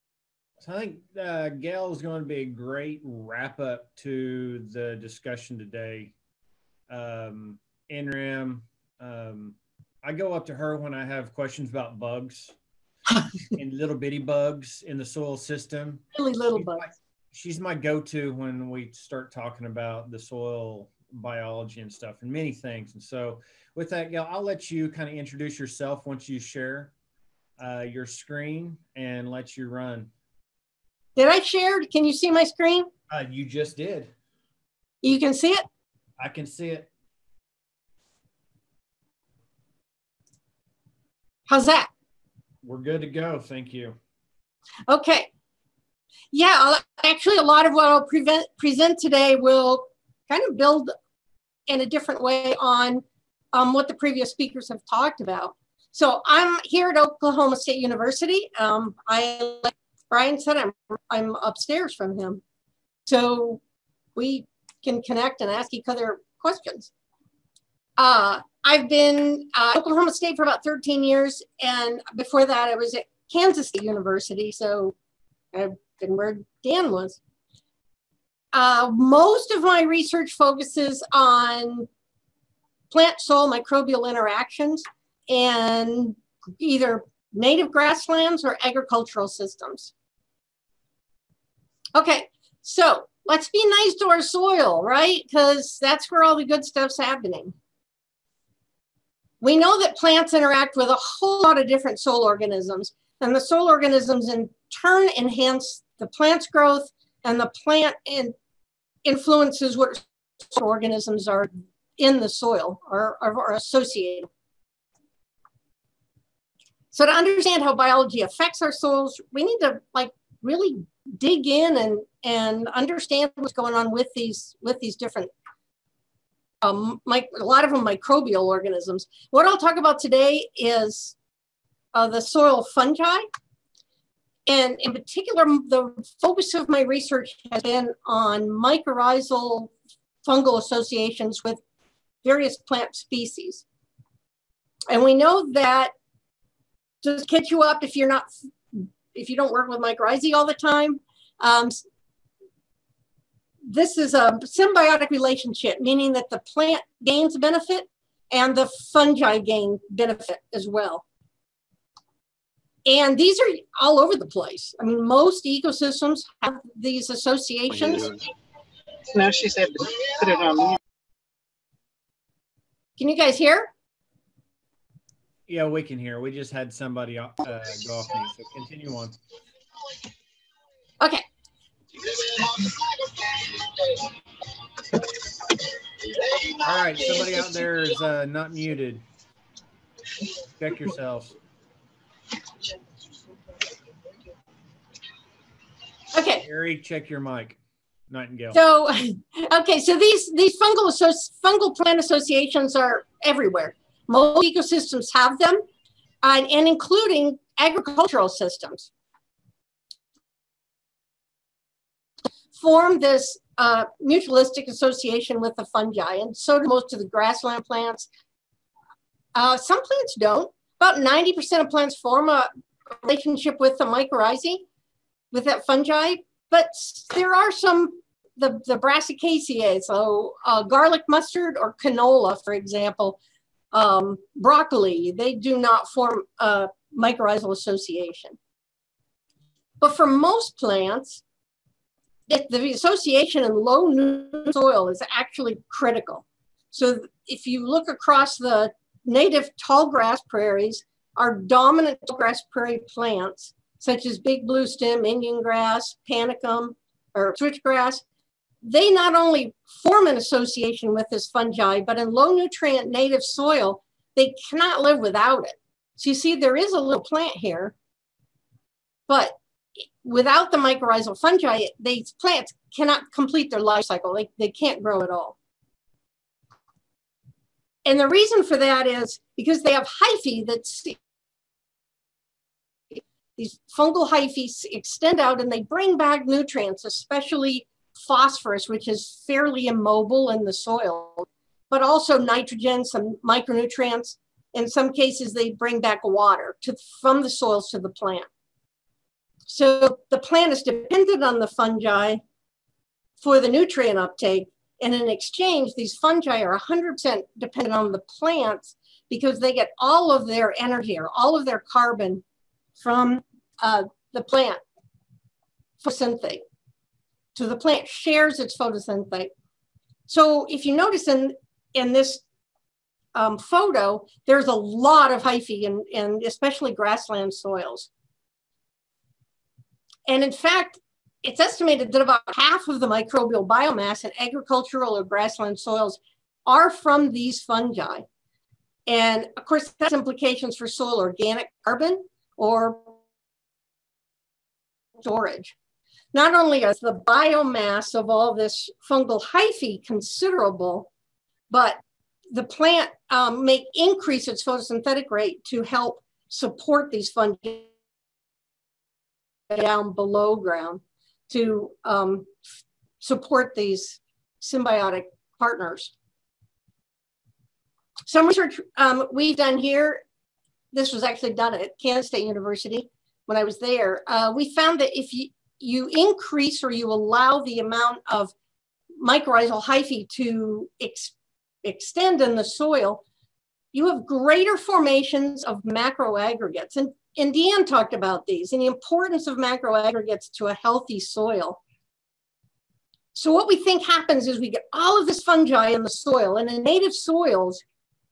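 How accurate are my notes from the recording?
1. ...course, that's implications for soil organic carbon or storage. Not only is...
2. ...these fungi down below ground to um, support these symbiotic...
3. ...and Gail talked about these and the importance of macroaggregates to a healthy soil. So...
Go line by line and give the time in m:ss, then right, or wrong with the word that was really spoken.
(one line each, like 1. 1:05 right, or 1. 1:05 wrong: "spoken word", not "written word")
1. 5:39 right
2. 5:56 right
3. 6:27 wrong: "Deanne", not "Gail".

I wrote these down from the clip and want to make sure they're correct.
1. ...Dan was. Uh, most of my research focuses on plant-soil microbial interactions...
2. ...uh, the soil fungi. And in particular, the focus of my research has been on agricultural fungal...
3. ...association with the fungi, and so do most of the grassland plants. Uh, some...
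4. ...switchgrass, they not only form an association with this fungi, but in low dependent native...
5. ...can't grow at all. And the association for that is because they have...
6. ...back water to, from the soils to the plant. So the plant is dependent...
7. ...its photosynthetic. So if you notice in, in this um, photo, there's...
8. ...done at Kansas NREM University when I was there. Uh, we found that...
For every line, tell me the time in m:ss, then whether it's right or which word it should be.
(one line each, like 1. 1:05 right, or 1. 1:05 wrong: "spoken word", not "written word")
1. 1:16 right
2. 2:11 wrong: "mycorrhizal", not "agricultural"
3. 3:34 right
4. 4:17 wrong: "nutrient", not "dependent"
5. 4:34 wrong: "reason", not "association"
6. 4:55 right
7. 5:18 right
8. 6:11 wrong: "State", not "NREM".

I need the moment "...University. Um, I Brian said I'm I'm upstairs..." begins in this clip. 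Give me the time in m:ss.
0:57.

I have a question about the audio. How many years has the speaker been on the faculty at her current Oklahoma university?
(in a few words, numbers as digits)
13.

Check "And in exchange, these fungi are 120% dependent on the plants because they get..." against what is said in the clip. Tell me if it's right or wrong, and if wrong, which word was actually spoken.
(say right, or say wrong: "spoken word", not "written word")
wrong: "100", not "120".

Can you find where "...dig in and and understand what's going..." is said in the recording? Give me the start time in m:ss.
2:01.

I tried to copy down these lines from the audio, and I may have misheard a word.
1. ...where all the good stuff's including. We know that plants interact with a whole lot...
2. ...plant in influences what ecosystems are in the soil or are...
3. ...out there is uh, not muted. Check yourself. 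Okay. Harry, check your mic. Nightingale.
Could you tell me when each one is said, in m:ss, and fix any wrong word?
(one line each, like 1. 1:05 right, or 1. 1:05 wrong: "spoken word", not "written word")
1. 1:36 wrong: "happening", not "including"
2. 1:47 wrong: "organisms", not "ecosystems"
3. 3:07 right.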